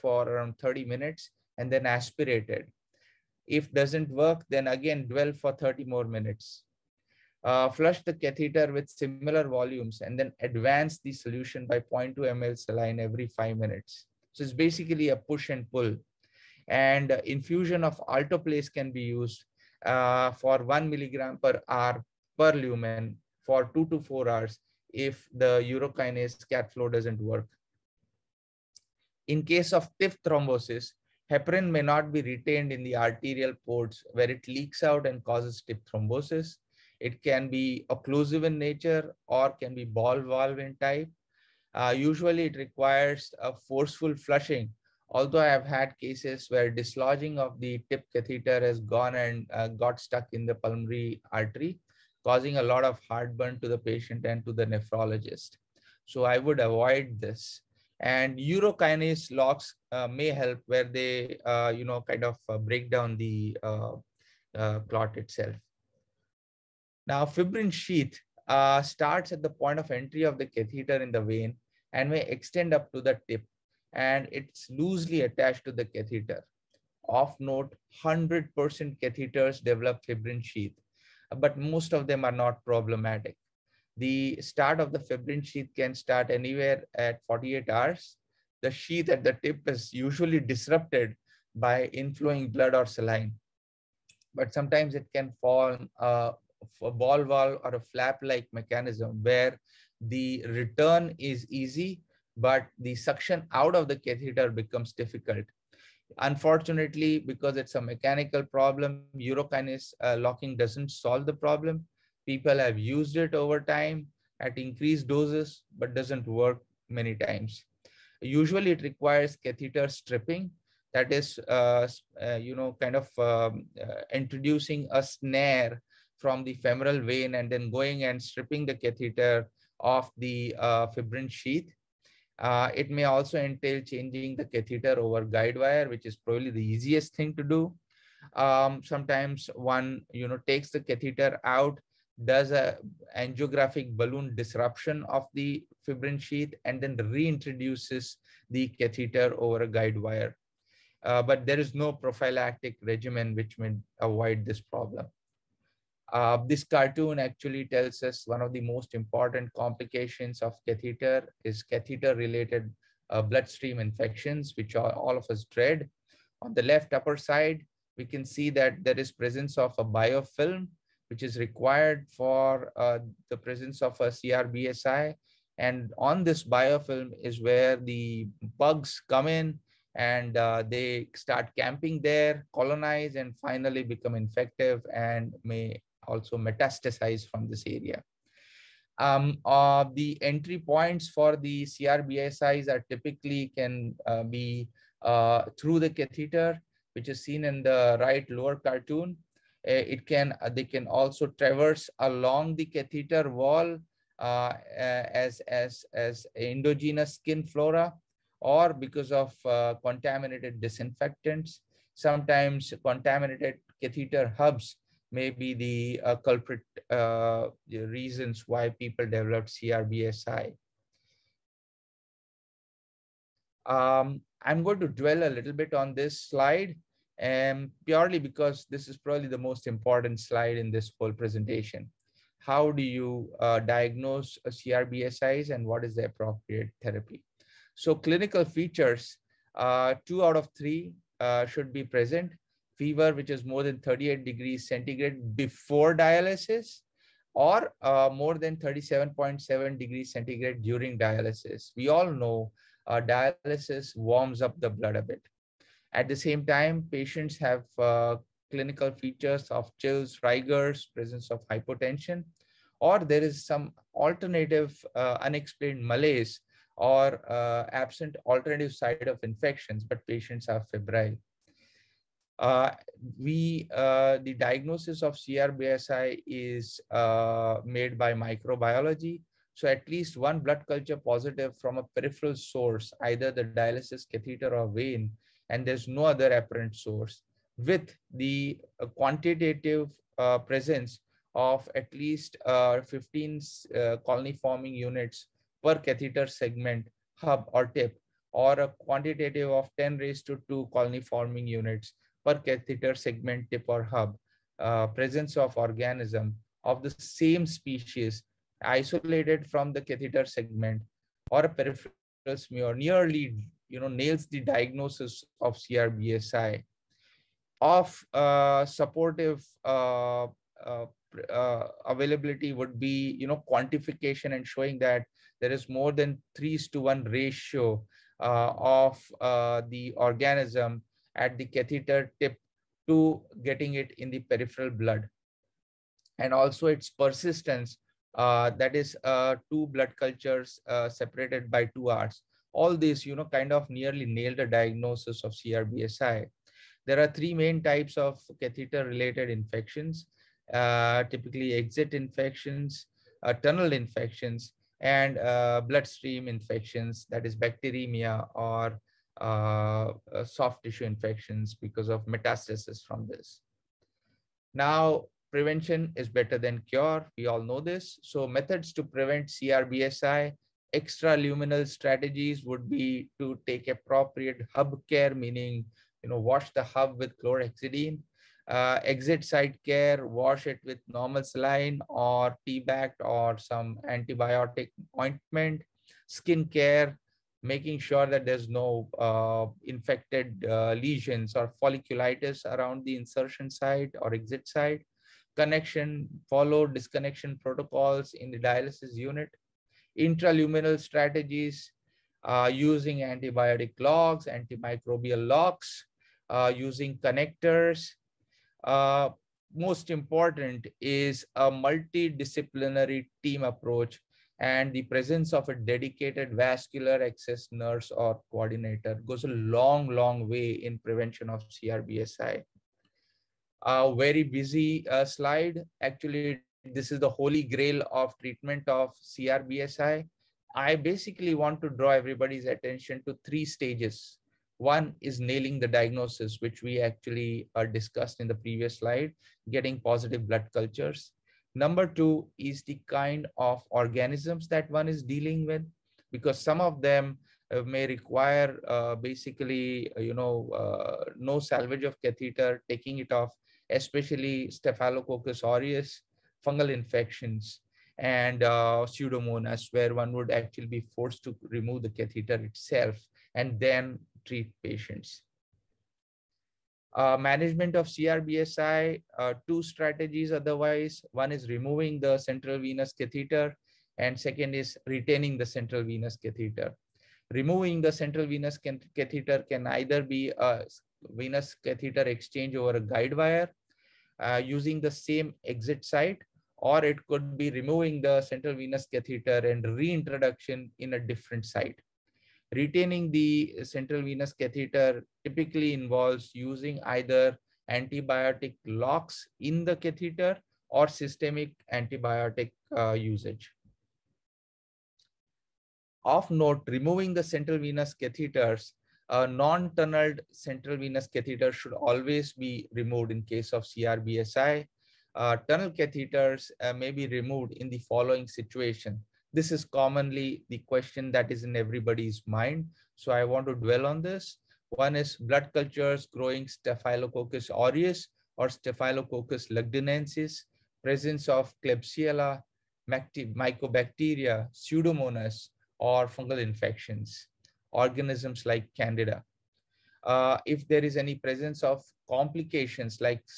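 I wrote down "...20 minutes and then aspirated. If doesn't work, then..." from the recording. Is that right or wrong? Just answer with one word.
wrong.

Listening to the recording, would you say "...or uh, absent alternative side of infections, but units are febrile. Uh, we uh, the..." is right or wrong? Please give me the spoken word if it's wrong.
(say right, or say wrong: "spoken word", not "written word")
wrong: "patients", not "units".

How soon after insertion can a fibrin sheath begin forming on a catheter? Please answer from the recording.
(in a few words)
48 hours.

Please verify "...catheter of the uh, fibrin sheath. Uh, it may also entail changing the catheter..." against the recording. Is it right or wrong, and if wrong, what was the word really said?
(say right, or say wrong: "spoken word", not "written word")
right.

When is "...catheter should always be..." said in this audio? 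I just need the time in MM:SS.
08:31.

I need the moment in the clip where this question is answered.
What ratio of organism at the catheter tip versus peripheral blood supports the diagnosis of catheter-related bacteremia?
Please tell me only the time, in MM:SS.
05:26.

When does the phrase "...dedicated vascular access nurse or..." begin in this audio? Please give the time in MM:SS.
06:55.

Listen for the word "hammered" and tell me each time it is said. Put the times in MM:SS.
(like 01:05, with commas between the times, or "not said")
not said.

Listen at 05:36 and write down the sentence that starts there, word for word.
And also its persistence, uh, that is uh, two blood cultures uh, separated by two hours.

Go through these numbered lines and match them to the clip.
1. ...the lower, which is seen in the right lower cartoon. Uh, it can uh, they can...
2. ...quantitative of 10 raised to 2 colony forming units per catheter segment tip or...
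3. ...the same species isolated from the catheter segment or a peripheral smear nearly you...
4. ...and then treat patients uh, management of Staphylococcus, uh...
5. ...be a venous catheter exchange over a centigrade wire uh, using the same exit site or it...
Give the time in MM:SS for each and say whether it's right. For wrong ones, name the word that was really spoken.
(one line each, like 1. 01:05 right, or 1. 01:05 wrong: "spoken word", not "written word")
1. 03:15 wrong: "catheter", not "lower"
2. 04:58 right
3. 05:06 right
4. 07:43 wrong: "CRBSI", not "Staphylococcus"
5. 08:00 wrong: "guide", not "centigrade".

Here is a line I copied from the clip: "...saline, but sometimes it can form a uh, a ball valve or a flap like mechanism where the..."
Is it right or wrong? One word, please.
right.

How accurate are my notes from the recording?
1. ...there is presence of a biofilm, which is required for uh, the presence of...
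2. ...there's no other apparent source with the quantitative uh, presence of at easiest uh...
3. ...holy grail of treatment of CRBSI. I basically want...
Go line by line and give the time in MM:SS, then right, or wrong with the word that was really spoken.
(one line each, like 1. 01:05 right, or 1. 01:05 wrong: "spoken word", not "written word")
1. 02:48 right
2. 04:45 wrong: "least", not "easiest"
3. 07:07 right.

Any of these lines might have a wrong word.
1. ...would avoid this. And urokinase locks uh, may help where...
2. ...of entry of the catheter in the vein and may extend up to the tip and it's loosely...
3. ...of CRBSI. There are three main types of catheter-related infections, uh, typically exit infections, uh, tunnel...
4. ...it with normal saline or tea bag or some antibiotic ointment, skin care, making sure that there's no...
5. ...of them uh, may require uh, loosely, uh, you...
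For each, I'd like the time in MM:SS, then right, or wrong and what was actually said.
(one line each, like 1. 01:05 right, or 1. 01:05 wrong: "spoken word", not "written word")
1. 00:56 right
2. 01:09 right
3. 05:45 right
4. 06:20 right
5. 07:26 wrong: "basically", not "loosely".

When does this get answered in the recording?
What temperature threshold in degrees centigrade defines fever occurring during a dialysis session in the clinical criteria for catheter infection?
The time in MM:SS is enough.
04:08.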